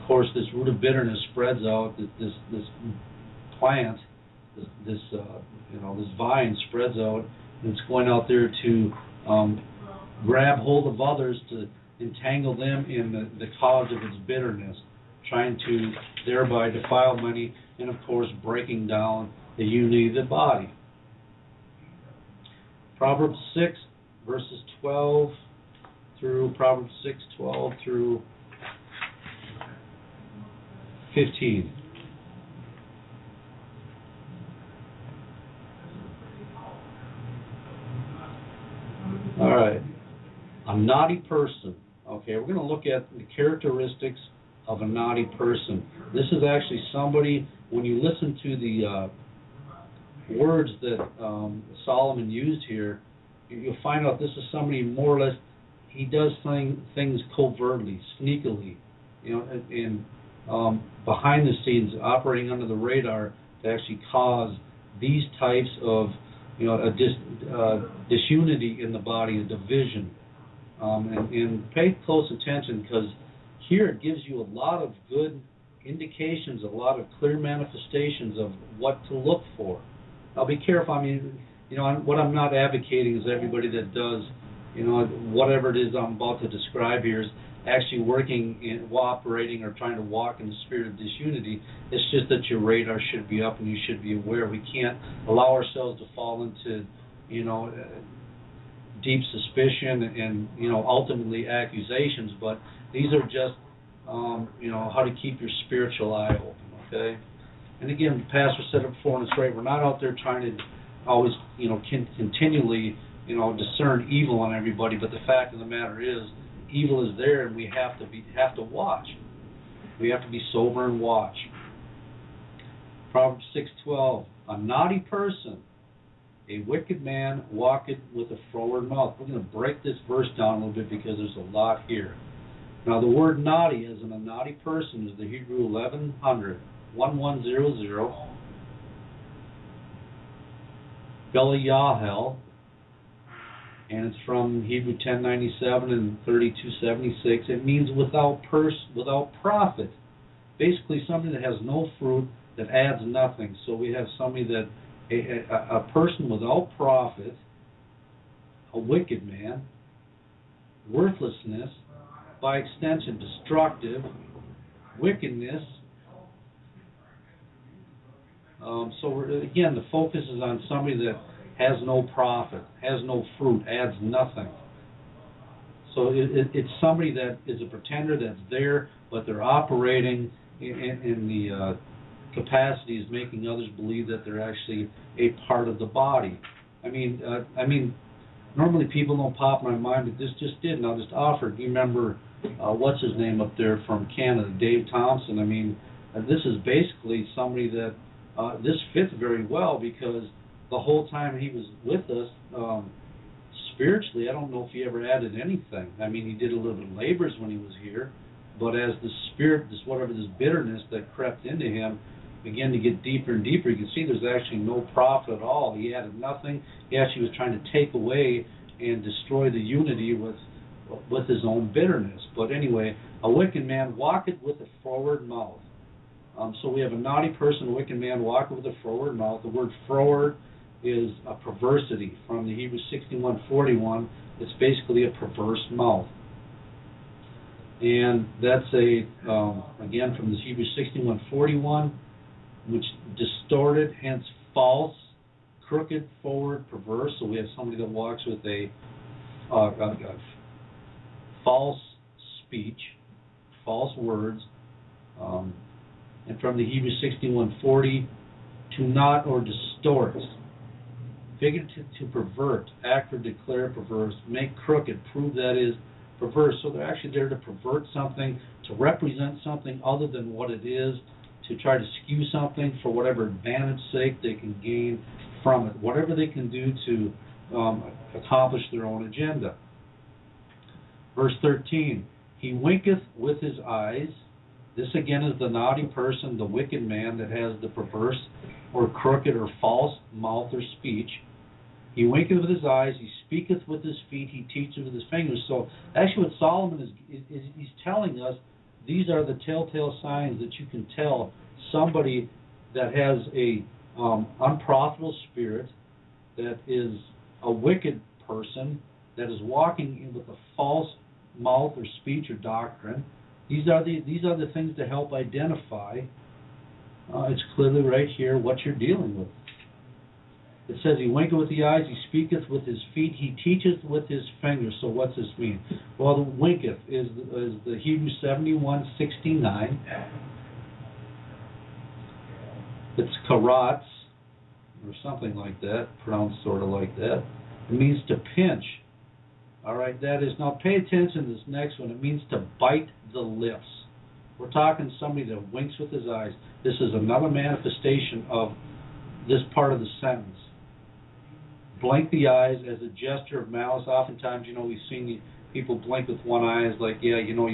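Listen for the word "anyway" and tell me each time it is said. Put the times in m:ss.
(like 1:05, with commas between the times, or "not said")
3:42.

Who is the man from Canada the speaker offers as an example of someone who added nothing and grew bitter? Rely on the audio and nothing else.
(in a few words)
Dave Thompson.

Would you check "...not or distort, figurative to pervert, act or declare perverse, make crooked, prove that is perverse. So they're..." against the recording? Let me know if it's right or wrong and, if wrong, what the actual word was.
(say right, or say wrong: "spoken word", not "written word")
right.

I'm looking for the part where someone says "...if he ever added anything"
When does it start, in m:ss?
3:24.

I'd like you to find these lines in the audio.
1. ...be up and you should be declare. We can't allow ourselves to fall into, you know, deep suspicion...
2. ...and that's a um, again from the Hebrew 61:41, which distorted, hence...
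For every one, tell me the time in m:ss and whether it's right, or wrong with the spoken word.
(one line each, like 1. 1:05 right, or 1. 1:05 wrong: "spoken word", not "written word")
1. 1:33 wrong: "aware", not "declare"
2. 3:57 right.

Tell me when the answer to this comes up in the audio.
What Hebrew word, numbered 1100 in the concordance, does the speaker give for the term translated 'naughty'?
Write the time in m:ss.
2:21.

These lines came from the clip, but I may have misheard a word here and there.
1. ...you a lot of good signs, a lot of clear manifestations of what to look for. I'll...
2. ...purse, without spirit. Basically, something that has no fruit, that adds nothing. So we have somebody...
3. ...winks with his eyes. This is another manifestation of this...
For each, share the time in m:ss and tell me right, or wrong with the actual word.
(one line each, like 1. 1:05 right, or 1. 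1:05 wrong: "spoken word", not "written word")
1. 1:14 wrong: "indications", not "signs"
2. 2:28 wrong: "profit", not "spirit"
3. 5:45 right.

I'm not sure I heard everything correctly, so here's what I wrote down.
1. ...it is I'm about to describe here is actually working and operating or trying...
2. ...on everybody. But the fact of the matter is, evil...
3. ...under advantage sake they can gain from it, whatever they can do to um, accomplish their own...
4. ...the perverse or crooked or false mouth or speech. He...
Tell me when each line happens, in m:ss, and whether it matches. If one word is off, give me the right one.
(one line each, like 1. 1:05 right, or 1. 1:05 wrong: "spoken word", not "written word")
1. 1:25 right
2. 1:54 right
3. 4:32 wrong: "whatever", not "under"
4. 4:47 right.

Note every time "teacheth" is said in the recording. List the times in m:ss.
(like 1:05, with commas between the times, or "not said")
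4:54, 5:23.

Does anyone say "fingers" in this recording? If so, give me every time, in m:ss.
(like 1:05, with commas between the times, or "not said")
4:55, 5:24.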